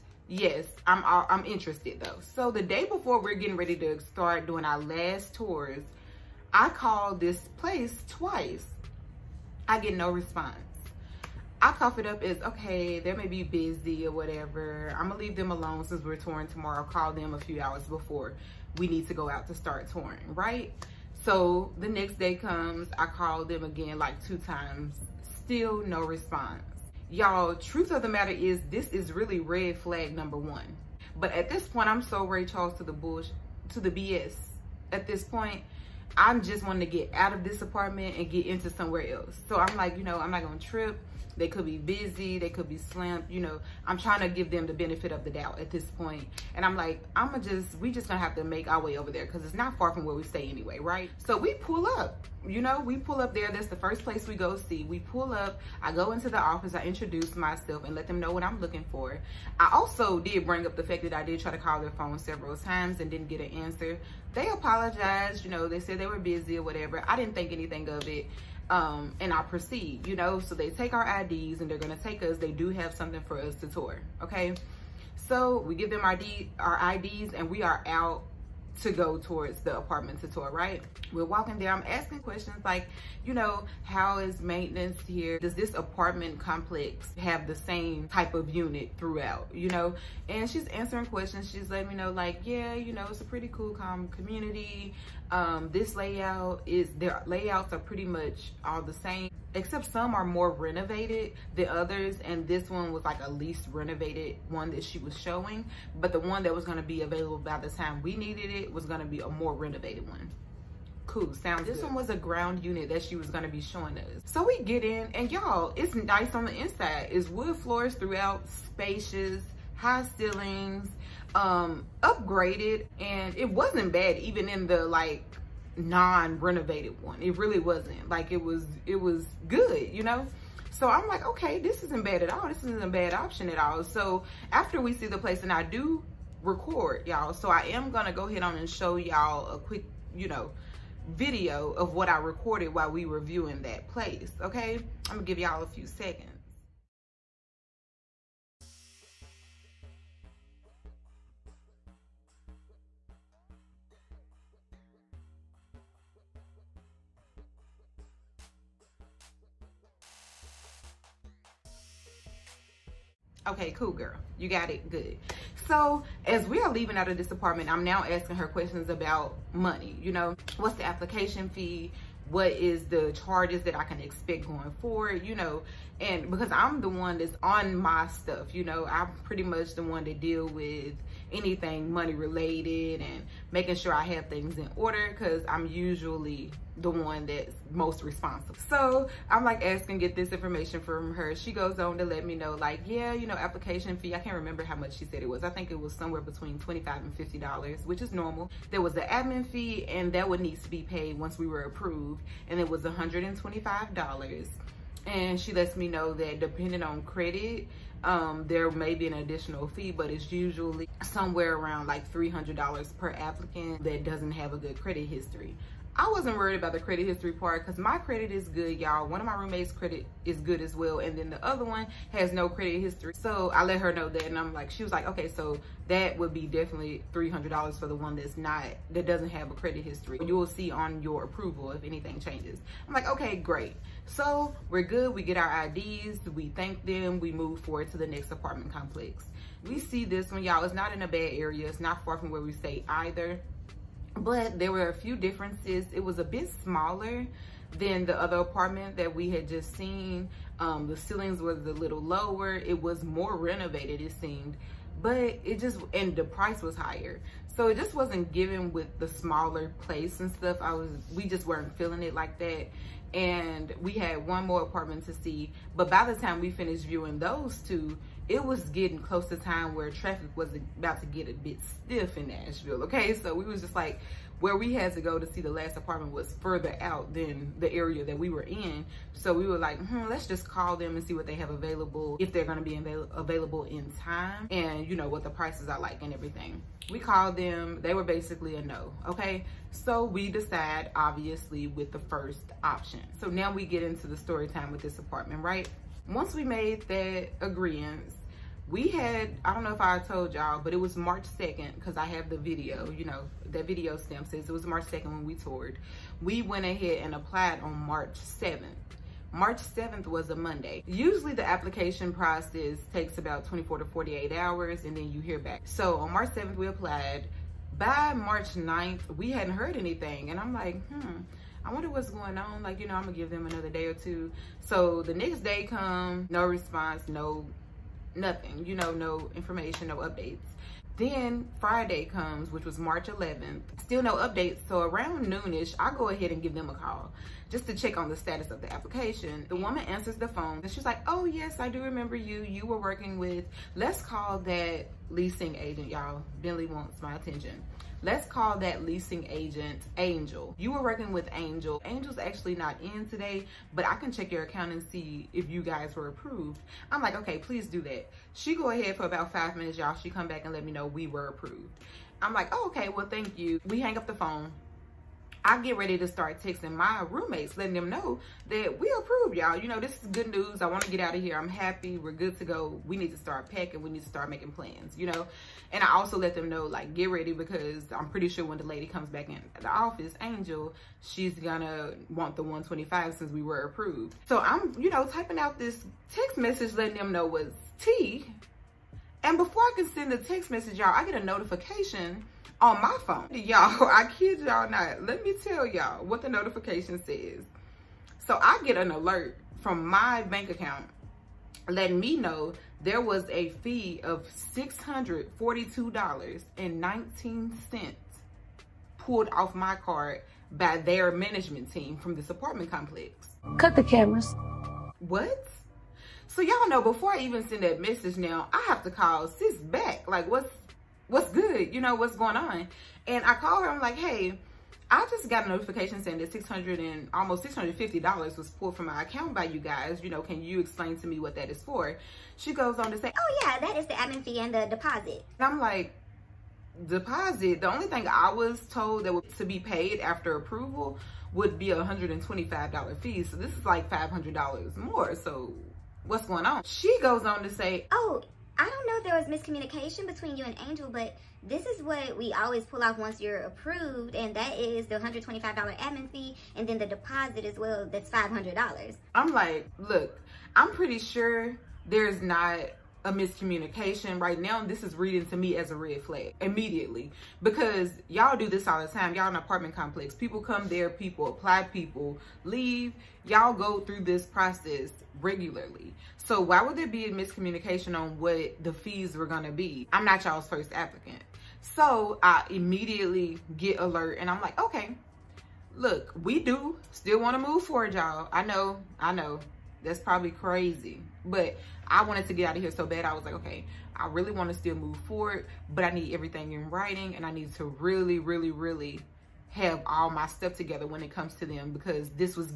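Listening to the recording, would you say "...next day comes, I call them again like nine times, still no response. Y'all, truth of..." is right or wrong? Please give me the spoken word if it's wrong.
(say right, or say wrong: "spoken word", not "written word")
wrong: "two", not "nine".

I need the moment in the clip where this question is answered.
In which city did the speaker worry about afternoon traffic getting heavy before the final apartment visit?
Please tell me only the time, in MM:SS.
04:32.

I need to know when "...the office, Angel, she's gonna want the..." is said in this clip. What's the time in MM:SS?
06:19.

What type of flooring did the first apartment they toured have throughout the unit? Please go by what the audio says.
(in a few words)
wood floors.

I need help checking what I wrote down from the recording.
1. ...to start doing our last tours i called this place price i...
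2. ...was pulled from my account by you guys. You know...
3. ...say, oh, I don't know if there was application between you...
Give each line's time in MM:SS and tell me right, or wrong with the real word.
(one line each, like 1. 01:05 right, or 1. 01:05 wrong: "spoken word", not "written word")
1. 00:03 wrong: "twice", not "price"
2. 07:08 right
3. 07:27 wrong: "miscommunication", not "application".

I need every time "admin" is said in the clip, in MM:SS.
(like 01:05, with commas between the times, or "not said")
03:19, 07:13, 07:35.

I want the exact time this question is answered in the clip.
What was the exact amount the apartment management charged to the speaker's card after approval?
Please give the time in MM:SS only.
06:44.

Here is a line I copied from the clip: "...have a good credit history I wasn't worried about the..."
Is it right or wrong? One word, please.
right.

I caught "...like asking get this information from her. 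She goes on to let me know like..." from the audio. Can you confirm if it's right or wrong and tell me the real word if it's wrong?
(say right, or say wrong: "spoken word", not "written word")
right.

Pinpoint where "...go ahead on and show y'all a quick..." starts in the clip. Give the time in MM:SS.
02:18.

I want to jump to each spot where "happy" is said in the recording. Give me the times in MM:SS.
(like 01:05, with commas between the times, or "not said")
06:11.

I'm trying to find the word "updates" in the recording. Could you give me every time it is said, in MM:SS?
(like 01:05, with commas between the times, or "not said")
05:29, 05:34.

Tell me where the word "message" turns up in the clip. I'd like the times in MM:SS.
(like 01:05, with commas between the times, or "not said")
06:26, 06:30, 06:57.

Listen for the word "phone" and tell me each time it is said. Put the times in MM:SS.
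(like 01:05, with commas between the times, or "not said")
01:01, 05:40, 06:04, 06:33.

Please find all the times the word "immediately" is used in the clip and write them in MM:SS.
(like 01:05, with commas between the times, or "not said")
07:46, 08:02.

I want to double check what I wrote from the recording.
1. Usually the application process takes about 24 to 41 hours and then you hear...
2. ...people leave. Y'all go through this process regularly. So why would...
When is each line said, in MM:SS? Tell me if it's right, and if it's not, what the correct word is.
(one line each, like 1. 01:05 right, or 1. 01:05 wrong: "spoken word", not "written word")
1. 05:10 wrong: "48", not "41"
2. 07:51 right.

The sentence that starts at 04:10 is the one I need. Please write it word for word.
Um, the ceilings was a little lower.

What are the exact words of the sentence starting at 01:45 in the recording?
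But the one that was gonna be available by the time we needed it was gonna be a more renovated one.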